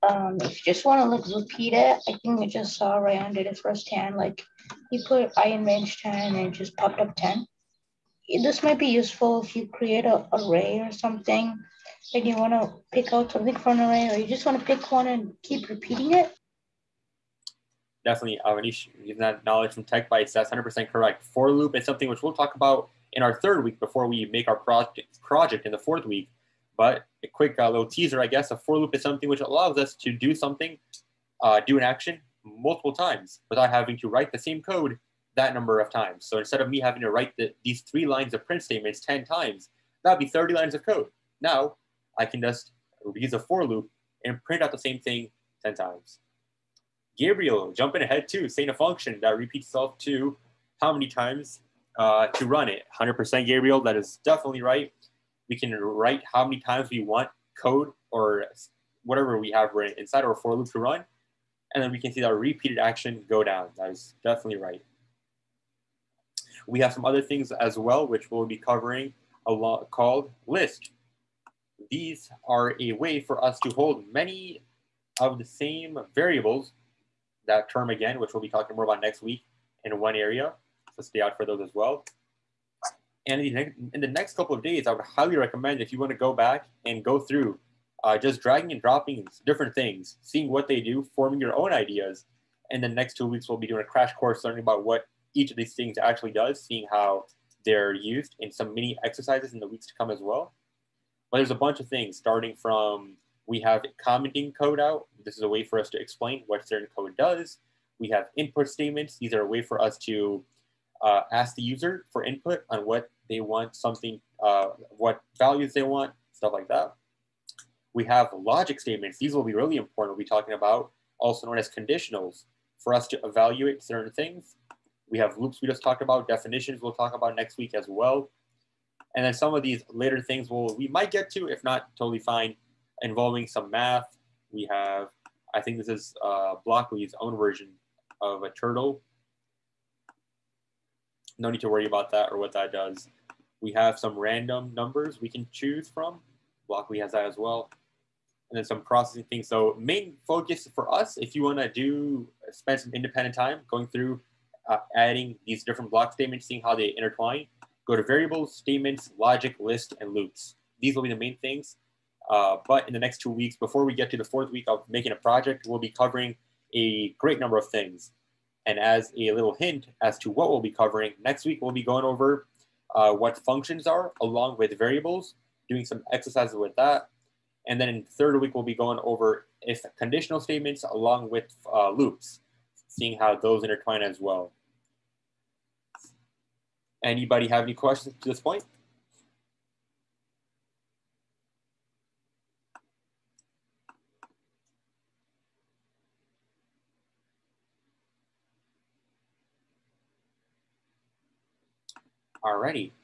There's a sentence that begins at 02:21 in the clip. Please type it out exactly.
No need to worry about that or what that does.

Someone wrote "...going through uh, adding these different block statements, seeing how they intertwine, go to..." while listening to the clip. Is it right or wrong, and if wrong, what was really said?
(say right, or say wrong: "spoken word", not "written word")
right.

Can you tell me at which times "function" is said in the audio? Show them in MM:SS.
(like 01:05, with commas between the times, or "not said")
00:48, 02:53.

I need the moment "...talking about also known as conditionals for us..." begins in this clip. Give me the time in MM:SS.
02:00.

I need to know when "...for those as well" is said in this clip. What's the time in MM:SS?
01:21.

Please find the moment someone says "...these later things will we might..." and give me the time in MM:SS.
02:09.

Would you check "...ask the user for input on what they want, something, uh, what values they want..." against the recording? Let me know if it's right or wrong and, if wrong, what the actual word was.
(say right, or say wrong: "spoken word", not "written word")
right.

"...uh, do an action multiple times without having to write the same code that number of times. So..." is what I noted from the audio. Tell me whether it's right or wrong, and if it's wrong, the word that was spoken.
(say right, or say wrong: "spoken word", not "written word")
right.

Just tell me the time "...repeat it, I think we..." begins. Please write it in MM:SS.
00:01.